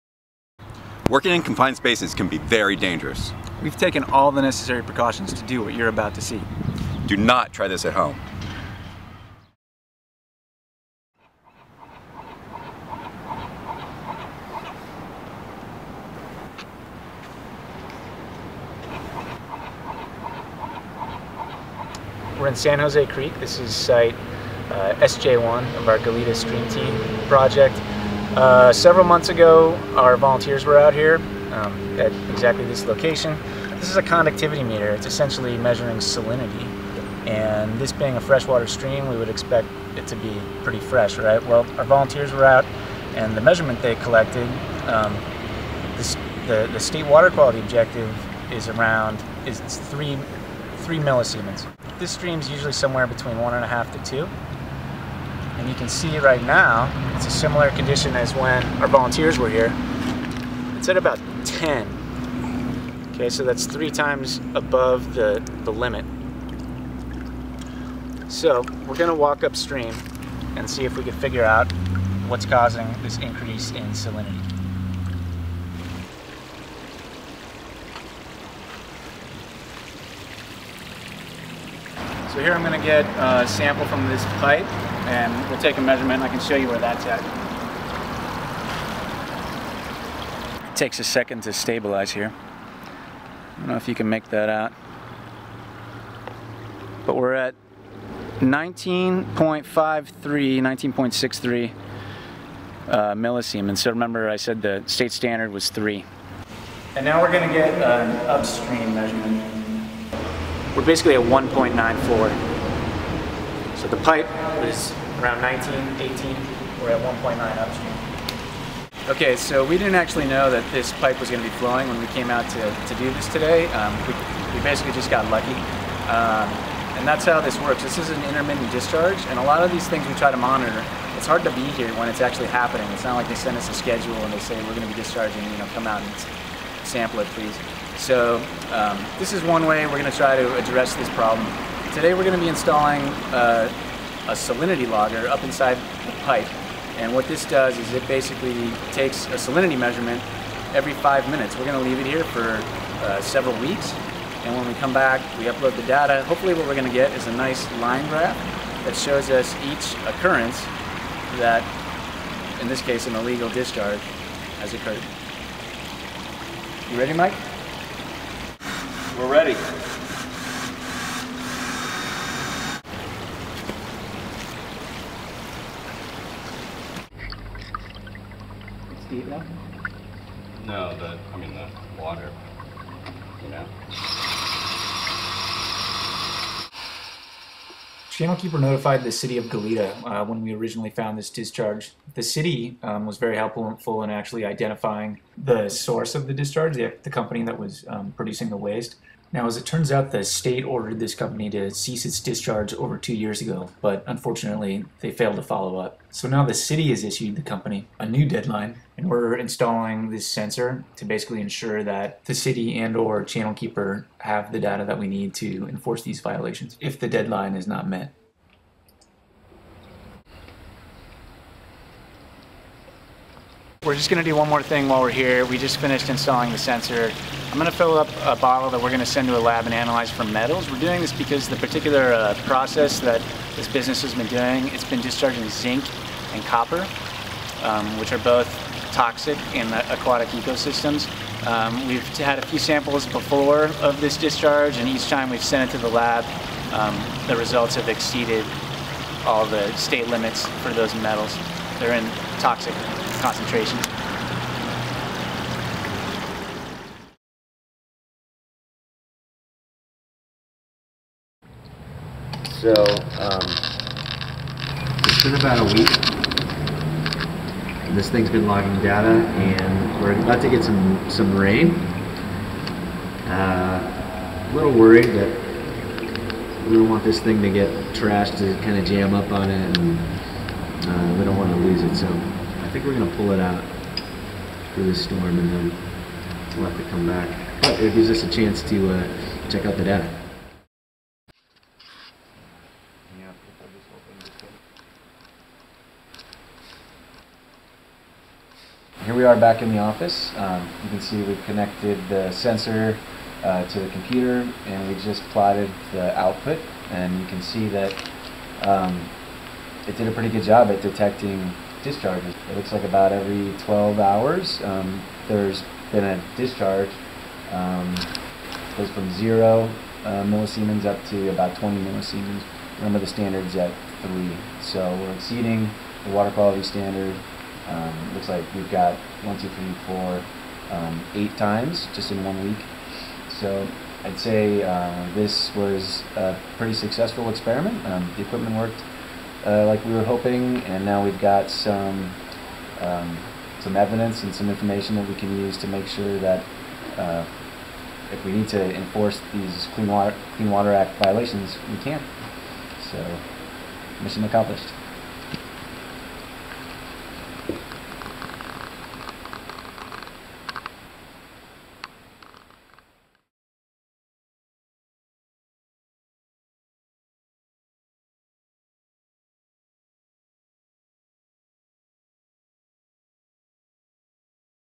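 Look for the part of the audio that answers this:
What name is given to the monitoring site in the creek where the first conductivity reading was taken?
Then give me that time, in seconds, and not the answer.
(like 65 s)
25 s.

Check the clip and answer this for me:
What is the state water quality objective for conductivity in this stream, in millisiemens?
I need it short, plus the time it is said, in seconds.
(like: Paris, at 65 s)
3, at 49 s.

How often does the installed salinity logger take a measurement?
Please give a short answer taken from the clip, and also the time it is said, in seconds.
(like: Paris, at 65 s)
Every 5 minutes, at 150 s.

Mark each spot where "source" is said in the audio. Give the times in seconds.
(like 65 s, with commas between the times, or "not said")
195 s.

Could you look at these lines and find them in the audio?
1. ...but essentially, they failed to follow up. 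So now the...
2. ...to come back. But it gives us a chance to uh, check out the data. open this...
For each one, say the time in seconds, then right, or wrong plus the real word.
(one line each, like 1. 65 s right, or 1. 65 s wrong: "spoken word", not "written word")
1. 203 s wrong: "unfortunately", not "essentially"
2. 286 s right.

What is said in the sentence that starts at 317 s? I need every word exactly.
Um, goes from zero uh, millisiemens up to about 20 millisiemens remember the standard's at 3.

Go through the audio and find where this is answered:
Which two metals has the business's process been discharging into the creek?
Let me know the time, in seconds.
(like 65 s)
235 s.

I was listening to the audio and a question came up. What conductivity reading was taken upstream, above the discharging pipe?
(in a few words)
1.94.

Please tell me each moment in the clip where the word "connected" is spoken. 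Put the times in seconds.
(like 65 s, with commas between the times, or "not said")
301 s.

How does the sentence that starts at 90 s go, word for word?
It takes a second to stabilize here.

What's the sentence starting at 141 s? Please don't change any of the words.
Today we're going to be installing uh, a salinity logger up inside the pipe.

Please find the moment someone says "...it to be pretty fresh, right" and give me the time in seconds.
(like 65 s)
39 s.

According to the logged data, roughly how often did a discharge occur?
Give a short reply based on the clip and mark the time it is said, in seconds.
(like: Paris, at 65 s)
Every 12 hours, at 313 s.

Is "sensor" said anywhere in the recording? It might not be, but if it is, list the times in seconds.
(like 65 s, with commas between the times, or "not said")
210 s, 226 s, 302 s.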